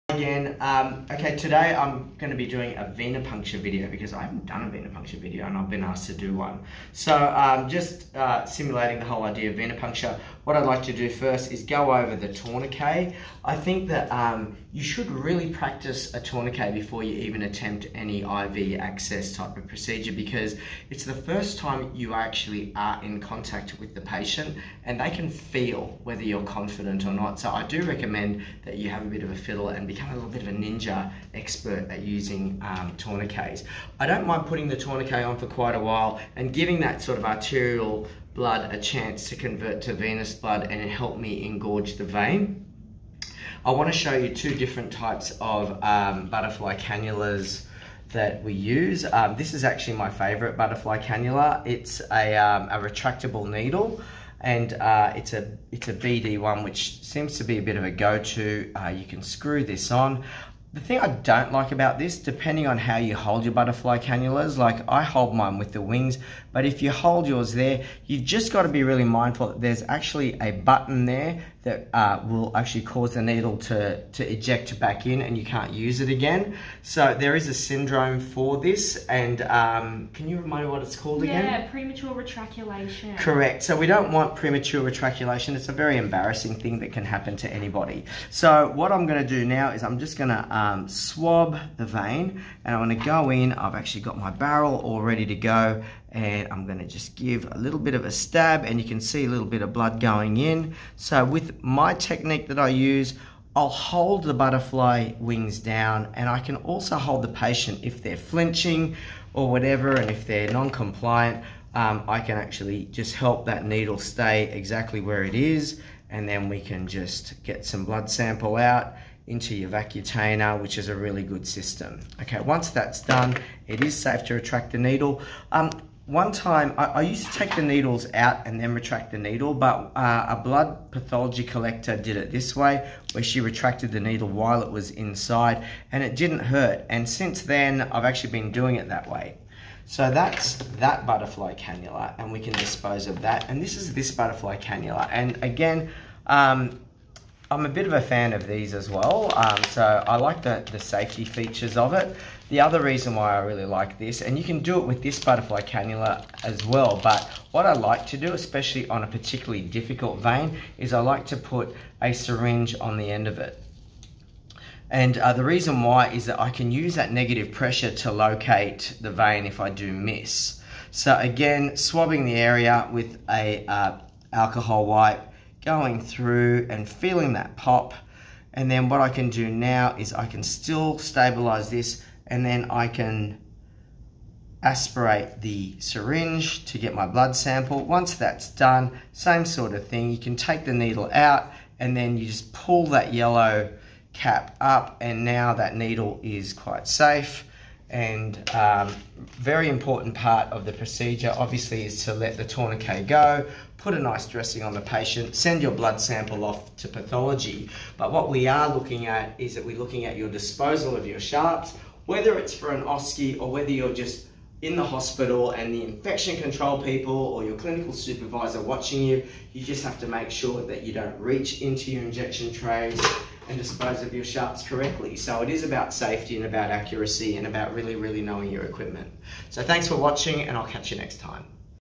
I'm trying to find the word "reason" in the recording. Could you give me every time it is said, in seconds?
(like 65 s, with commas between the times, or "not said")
152 s, 165 s.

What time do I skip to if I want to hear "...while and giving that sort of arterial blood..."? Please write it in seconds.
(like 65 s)
35 s.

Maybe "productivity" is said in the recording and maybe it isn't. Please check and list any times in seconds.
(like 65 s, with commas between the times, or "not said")
not said.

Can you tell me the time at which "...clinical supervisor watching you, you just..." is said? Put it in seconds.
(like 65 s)
217 s.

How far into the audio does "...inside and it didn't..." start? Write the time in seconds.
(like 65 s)
134 s.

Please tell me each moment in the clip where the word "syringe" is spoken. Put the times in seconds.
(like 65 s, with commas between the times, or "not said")
162 s, 185 s.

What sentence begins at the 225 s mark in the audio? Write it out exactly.
So it is about safety and about accuracy and about really, really knowing your equipment.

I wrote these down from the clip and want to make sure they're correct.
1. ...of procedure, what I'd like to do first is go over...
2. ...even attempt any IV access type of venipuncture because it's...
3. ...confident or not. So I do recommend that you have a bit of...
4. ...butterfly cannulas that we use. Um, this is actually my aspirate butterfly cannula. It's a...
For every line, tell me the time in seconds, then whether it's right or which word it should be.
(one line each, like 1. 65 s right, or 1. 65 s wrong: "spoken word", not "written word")
1. 9 s wrong: "venipuncture", not "procedure"
2. 17 s wrong: "procedure", not "venipuncture"
3. 26 s right
4. 46 s wrong: "favorite", not "aspirate".